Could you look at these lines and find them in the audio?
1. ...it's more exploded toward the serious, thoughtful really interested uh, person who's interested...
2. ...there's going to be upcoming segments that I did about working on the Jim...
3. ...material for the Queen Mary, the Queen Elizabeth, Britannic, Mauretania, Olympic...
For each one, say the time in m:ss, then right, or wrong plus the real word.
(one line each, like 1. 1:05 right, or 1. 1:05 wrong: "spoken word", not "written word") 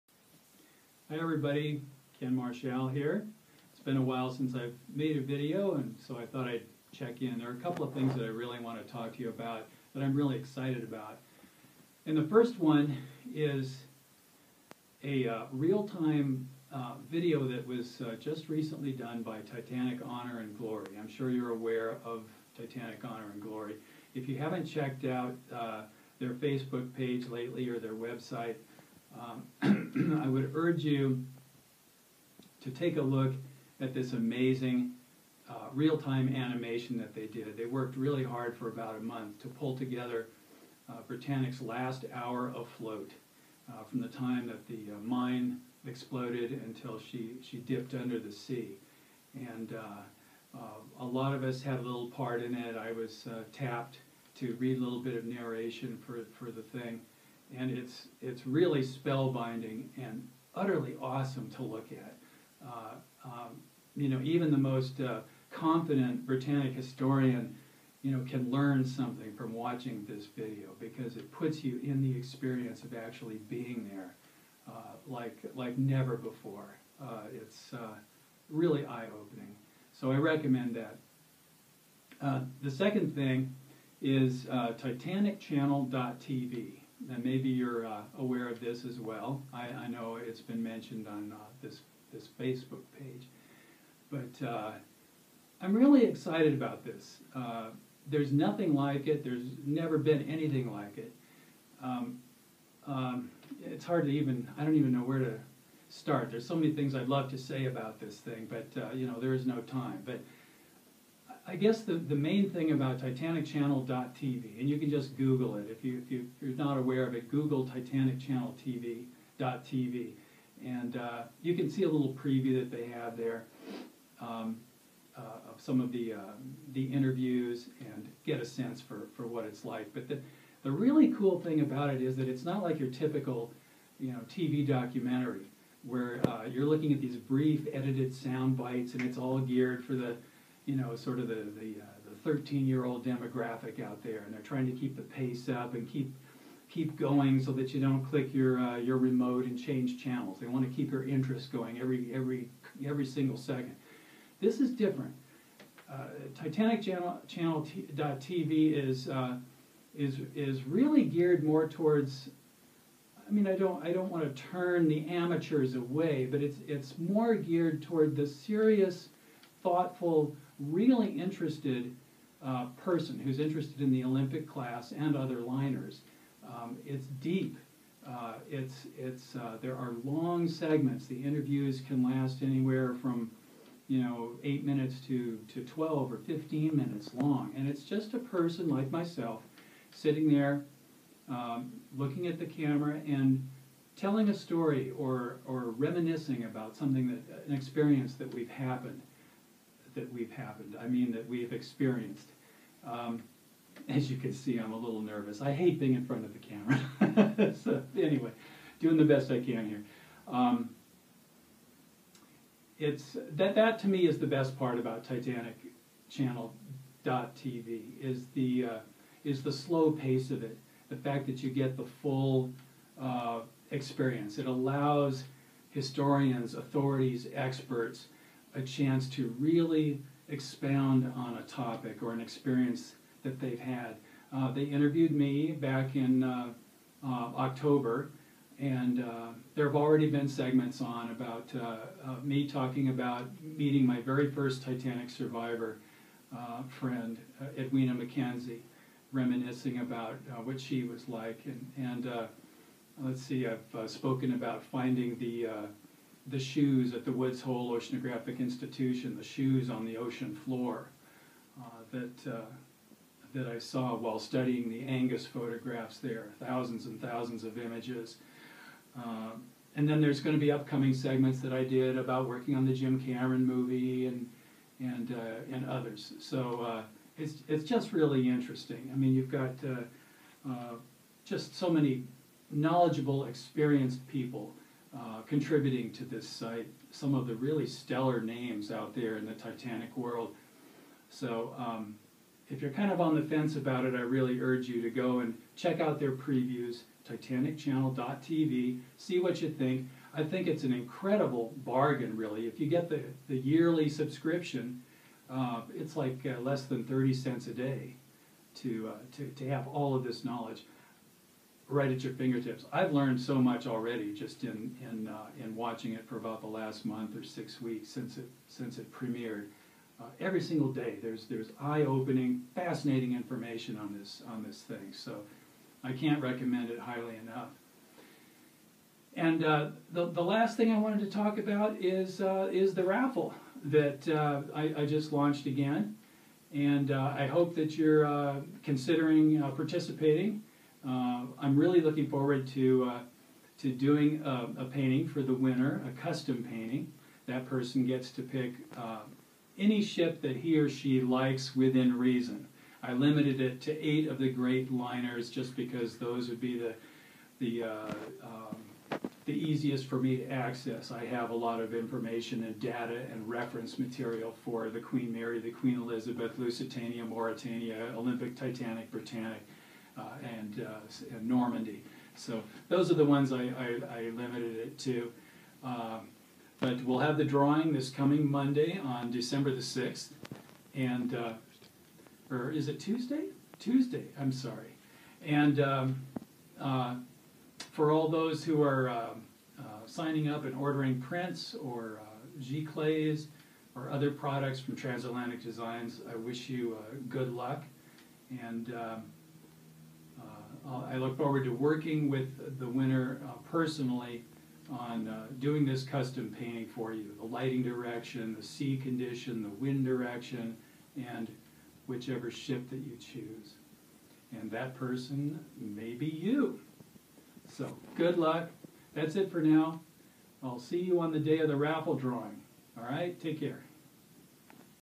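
1. 2:46 wrong: "geared", not "exploded"
2. 4:30 right
3. 6:03 wrong: "Lusitania", not "Britannic".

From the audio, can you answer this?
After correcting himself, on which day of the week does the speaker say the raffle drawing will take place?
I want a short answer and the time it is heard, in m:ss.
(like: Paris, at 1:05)
Tuesday, at 6:23.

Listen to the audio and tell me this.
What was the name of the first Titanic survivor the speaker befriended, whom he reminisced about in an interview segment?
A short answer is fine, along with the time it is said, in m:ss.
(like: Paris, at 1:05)
Edwina McKenzie, at 4:07.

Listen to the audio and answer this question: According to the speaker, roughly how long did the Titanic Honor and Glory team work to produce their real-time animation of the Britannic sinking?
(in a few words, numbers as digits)
About a month.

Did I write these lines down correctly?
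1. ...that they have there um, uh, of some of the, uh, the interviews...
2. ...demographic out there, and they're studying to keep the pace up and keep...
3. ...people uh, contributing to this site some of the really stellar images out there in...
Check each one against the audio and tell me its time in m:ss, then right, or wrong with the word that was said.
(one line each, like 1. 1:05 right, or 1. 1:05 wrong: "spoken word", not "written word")
1. 2:02 right
2. 2:23 wrong: "trying", not "studying"
3. 4:44 wrong: "names", not "images".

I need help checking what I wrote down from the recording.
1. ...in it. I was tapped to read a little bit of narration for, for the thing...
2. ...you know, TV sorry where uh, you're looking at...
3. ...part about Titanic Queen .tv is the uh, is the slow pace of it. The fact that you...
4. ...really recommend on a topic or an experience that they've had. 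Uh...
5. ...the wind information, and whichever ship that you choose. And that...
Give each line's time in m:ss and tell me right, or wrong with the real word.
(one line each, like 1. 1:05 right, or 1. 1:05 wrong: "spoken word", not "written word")
1. 0:52 right
2. 2:13 wrong: "documentary", not "sorry"
3. 3:34 wrong: "Channel", not "Queen"
4. 3:49 wrong: "expound", not "recommend"
5. 6:49 wrong: "direction", not "information".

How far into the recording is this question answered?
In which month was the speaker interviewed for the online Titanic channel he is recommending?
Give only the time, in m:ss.
3:57.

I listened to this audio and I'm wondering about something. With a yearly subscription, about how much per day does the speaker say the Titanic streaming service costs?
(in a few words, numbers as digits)
Less than 30 cents.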